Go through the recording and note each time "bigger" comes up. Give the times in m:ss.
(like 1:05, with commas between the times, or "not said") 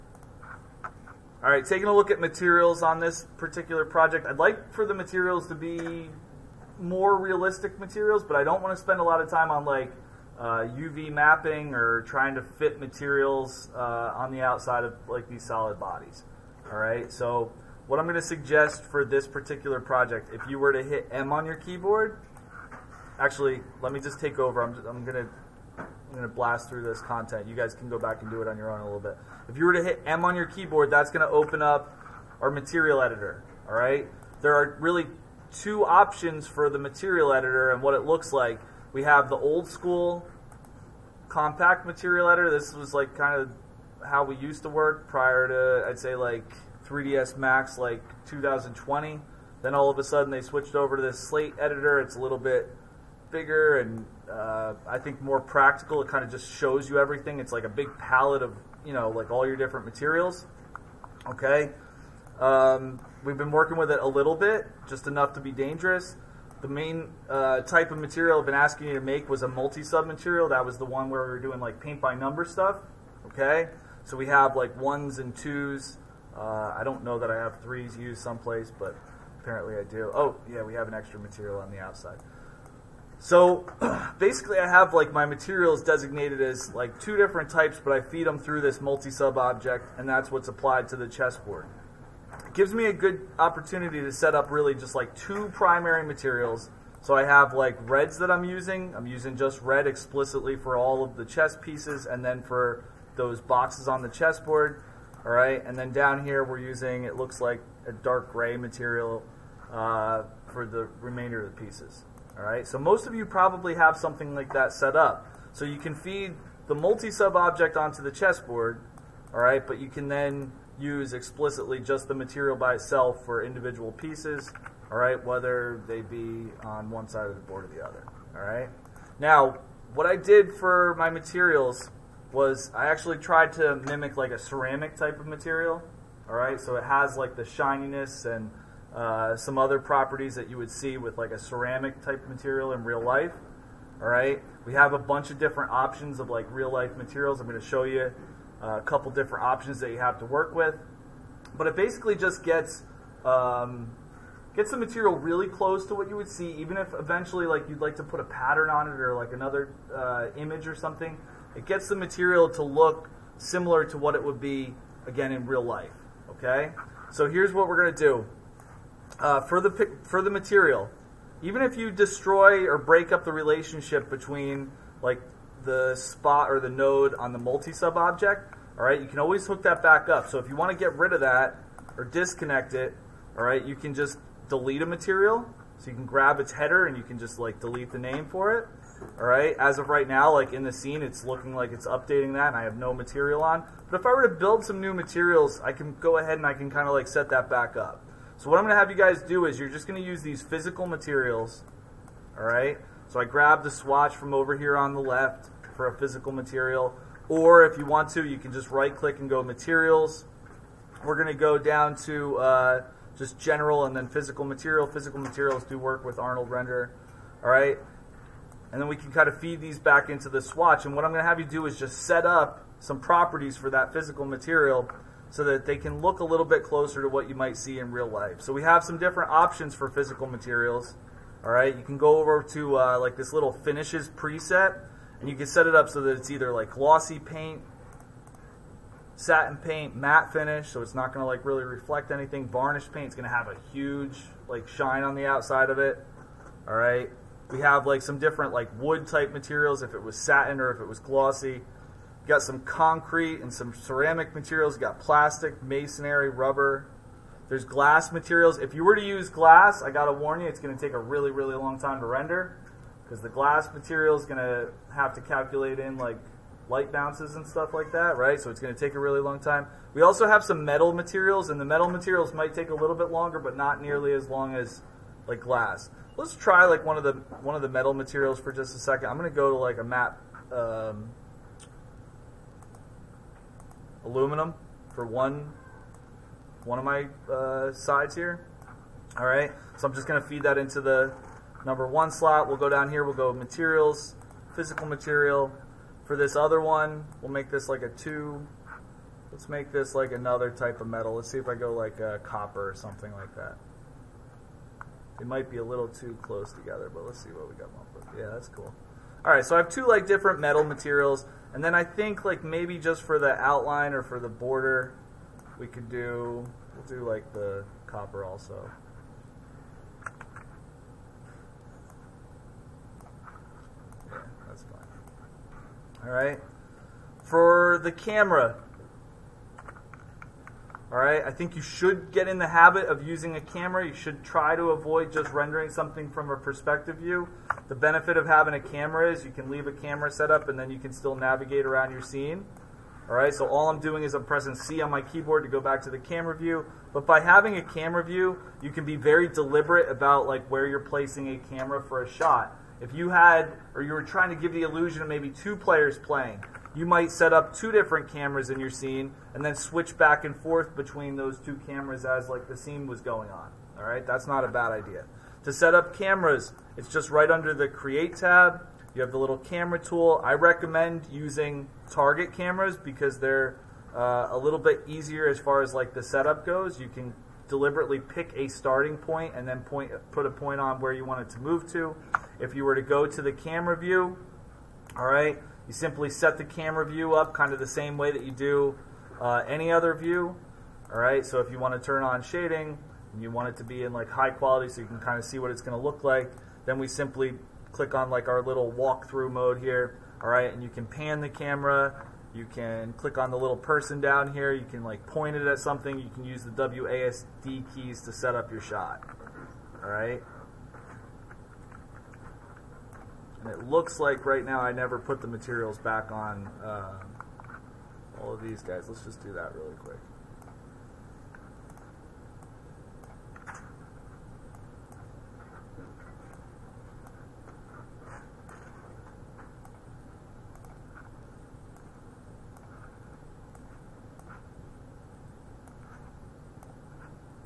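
0:53.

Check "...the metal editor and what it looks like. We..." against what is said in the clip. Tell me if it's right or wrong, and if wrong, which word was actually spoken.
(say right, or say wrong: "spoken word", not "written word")
wrong: "material", not "metal".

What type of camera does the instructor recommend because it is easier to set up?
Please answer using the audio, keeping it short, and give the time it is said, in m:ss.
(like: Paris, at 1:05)
Target cameras, at 6:11.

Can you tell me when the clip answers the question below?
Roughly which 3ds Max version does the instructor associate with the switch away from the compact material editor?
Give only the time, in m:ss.
0:48.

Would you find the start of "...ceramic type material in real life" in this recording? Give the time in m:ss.
2:21.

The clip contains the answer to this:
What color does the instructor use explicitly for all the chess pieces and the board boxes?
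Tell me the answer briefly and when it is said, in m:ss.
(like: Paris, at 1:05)
Red, at 1:39.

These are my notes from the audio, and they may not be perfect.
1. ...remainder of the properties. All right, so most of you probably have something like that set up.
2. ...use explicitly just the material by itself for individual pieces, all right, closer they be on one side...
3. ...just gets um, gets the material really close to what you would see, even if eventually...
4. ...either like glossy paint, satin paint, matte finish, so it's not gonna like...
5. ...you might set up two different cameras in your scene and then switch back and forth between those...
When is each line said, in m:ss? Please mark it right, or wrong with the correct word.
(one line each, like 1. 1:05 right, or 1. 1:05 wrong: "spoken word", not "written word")
1. 1:50 wrong: "pieces", not "properties"
2. 2:00 wrong: "whether", not "closer"
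3. 2:32 right
4. 3:56 right
5. 5:56 right.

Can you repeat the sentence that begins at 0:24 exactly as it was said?
I'm, I'm going to I'm going to blast through this content.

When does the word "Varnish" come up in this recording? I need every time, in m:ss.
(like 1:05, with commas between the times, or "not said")
4:02.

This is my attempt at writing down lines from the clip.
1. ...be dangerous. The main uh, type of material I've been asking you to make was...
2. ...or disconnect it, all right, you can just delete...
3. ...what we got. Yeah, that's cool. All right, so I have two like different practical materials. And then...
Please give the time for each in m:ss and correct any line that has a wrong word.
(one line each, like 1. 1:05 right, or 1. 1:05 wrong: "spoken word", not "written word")
1. 1:05 right
2. 3:01 right
3. 5:07 wrong: "metal", not "practical".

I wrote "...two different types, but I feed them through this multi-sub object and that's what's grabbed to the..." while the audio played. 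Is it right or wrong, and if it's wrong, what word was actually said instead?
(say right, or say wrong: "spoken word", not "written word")
wrong: "applied", not "grabbed".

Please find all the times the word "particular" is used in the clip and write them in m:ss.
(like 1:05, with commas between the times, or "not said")
0:03, 0:19.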